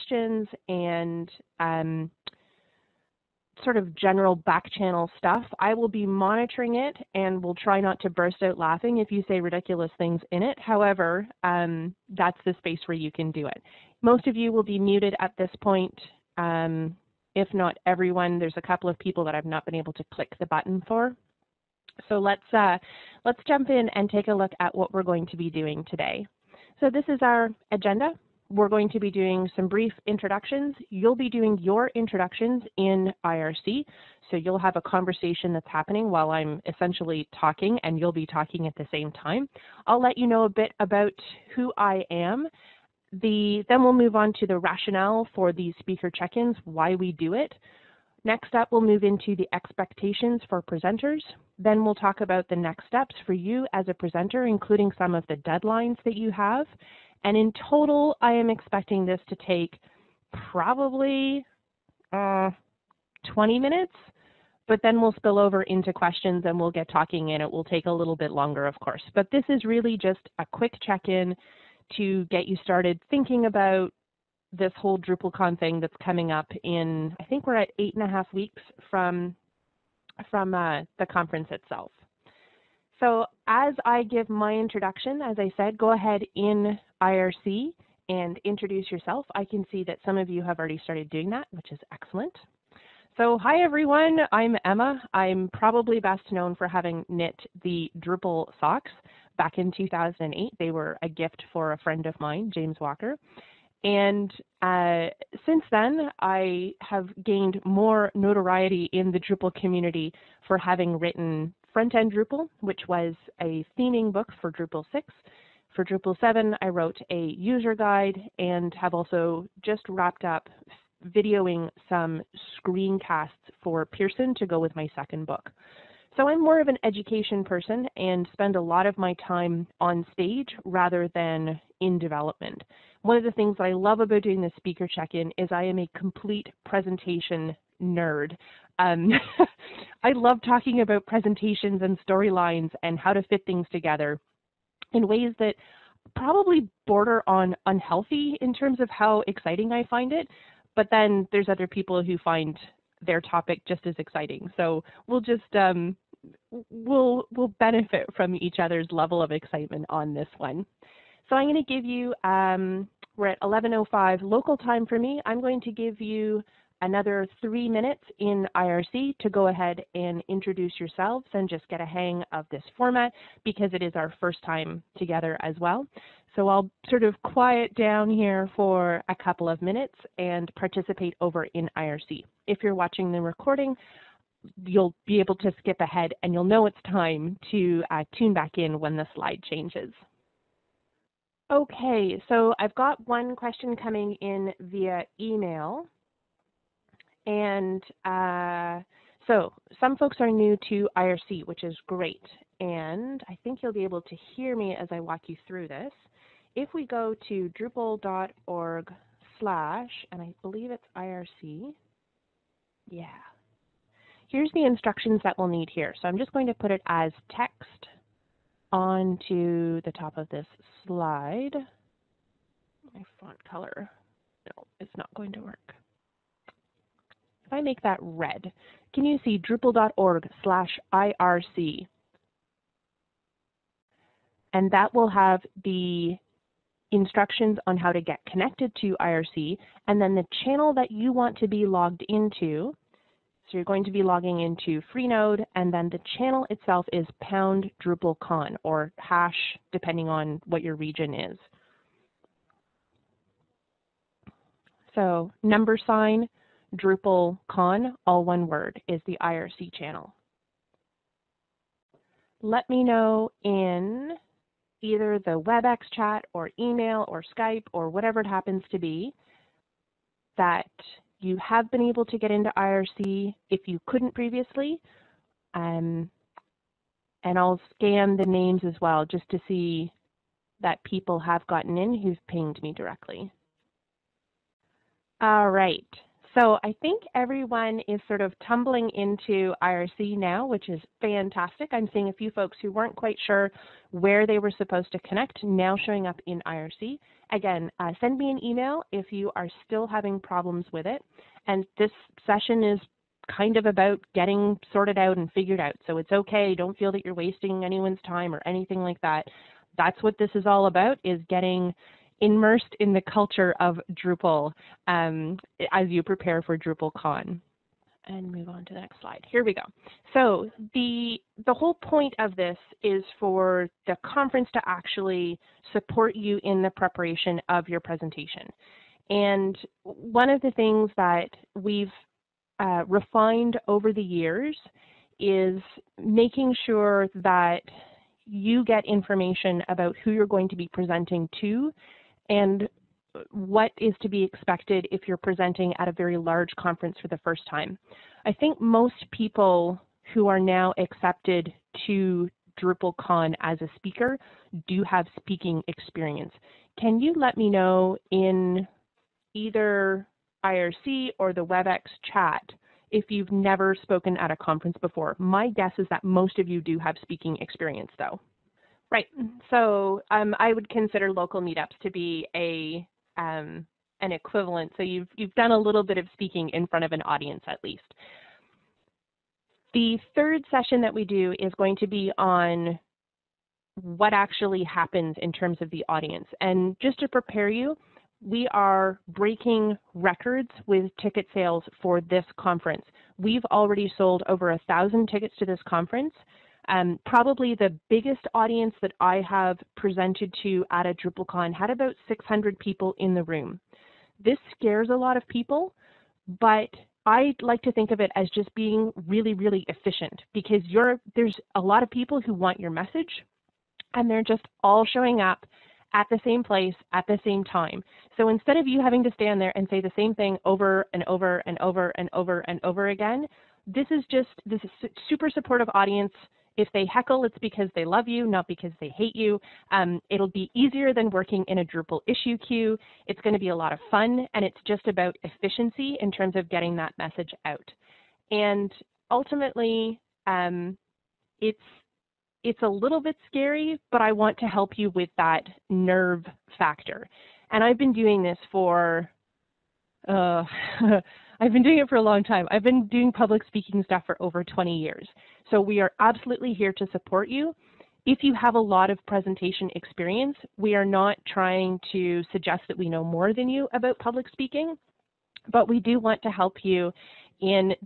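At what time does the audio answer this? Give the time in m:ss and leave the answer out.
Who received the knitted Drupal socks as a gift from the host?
1:42.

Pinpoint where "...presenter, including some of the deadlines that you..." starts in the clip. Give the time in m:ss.
0:53.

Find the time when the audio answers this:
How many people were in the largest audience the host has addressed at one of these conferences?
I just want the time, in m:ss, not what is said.
6:42.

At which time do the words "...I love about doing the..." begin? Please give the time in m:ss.
2:13.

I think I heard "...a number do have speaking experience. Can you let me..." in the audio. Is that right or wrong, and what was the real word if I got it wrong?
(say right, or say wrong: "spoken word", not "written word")
wrong: "speaker", not "number".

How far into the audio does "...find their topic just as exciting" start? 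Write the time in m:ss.
2:32.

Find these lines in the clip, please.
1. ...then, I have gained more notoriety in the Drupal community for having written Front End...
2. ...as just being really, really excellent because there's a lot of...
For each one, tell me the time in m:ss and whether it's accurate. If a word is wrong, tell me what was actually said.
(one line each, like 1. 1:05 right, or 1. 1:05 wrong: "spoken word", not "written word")
1. 1:45 right
2. 6:48 wrong: "efficient", not "excellent".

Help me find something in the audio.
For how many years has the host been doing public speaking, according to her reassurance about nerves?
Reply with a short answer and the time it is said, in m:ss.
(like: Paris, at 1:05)
over 20, at 7:34.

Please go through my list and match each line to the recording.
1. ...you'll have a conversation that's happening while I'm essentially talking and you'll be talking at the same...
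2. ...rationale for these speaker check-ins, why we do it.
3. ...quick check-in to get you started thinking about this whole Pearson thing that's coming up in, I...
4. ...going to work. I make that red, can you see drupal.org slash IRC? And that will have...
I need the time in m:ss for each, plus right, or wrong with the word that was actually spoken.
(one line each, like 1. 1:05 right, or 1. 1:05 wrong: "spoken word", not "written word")
1. 0:34 right
2. 0:44 right
3. 1:10 wrong: "DrupalCon", not "Pearson"
4. 3:45 right.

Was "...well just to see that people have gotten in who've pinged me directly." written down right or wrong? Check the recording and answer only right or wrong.
right.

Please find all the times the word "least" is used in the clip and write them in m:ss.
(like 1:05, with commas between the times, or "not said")
6:17.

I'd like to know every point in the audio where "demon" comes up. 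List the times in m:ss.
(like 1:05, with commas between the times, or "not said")
not said.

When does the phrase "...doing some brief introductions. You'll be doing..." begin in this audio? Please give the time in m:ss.
0:29.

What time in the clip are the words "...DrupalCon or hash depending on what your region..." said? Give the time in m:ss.
4:07.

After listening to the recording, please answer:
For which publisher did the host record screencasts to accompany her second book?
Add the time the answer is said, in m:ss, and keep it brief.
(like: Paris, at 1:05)
Pearson, at 2:03.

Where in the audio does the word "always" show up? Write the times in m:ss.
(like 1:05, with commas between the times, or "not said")
not said.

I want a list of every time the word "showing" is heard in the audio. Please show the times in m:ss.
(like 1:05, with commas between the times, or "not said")
4:55, 6:54.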